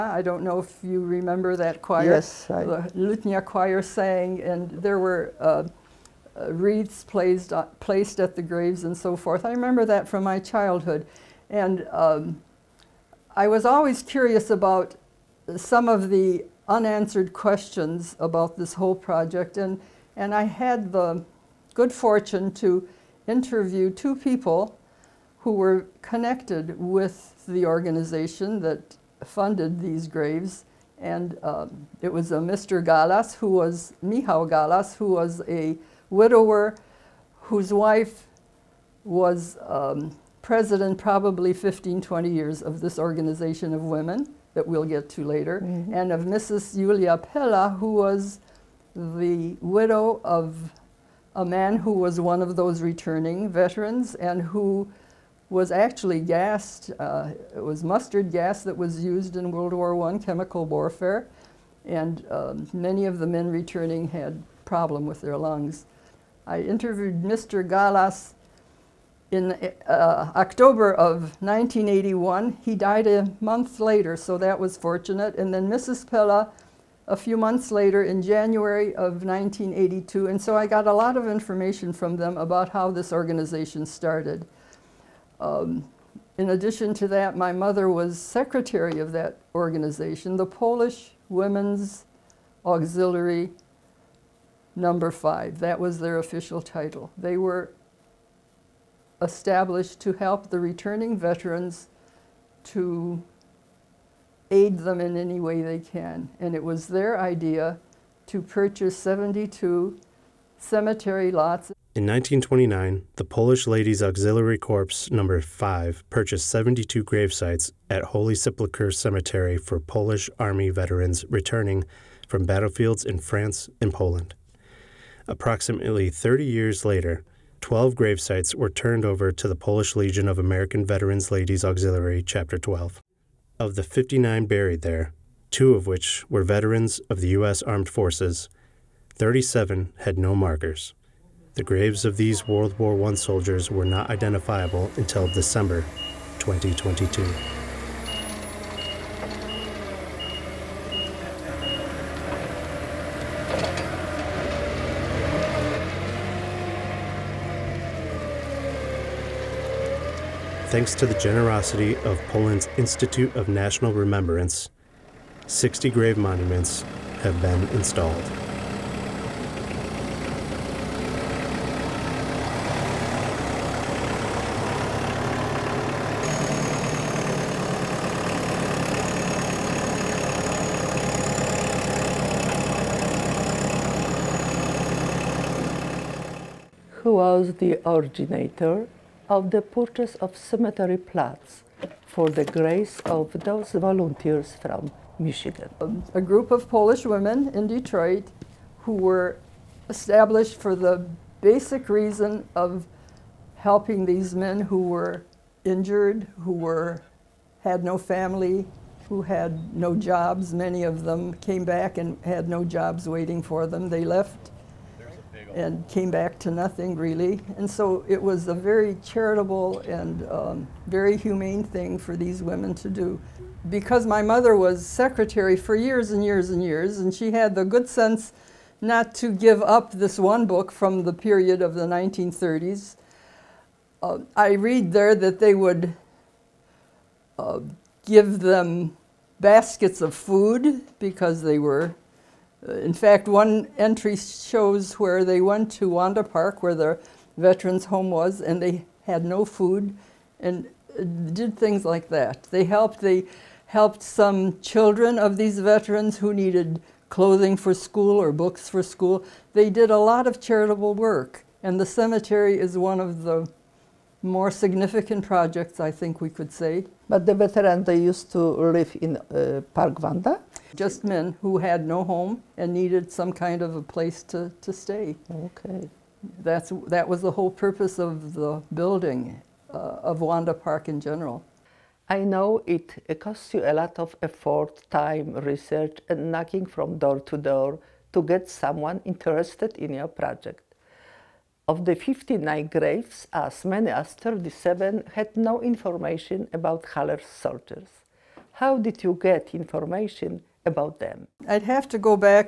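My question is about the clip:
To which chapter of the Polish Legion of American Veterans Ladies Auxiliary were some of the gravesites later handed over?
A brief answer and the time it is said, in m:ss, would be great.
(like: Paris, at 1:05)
Chapter 12, at 2:12.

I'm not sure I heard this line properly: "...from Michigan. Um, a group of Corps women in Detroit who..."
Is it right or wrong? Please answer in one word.
wrong.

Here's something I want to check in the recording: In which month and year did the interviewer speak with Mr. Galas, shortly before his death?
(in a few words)
October 1981.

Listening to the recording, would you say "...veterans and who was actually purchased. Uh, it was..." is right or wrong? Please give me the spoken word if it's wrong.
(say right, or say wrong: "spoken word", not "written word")
wrong: "gassed", not "purchased".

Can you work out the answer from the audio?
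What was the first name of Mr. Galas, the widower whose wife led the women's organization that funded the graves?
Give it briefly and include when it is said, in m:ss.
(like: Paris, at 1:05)
Michał, at 0:34.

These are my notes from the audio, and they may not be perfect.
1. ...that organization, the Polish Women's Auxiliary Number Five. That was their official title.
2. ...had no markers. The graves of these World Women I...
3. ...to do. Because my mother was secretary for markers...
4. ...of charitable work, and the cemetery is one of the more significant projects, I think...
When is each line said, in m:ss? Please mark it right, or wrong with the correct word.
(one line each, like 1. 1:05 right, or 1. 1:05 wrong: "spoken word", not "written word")
1. 1:29 right
2. 2:19 wrong: "War", not "Women"
3. 3:42 wrong: "years", not "markers"
4. 4:20 right.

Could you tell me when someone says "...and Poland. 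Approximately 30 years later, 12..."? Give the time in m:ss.
2:03.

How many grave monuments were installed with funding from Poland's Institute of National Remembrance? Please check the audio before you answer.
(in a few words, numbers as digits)
60.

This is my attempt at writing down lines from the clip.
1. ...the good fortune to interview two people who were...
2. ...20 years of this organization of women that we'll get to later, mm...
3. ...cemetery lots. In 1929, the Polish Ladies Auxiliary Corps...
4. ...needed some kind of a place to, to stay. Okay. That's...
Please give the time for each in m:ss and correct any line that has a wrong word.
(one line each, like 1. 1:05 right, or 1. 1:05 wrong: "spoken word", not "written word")
1. 0:20 right
2. 0:42 right
3. 1:50 right
4. 4:32 right.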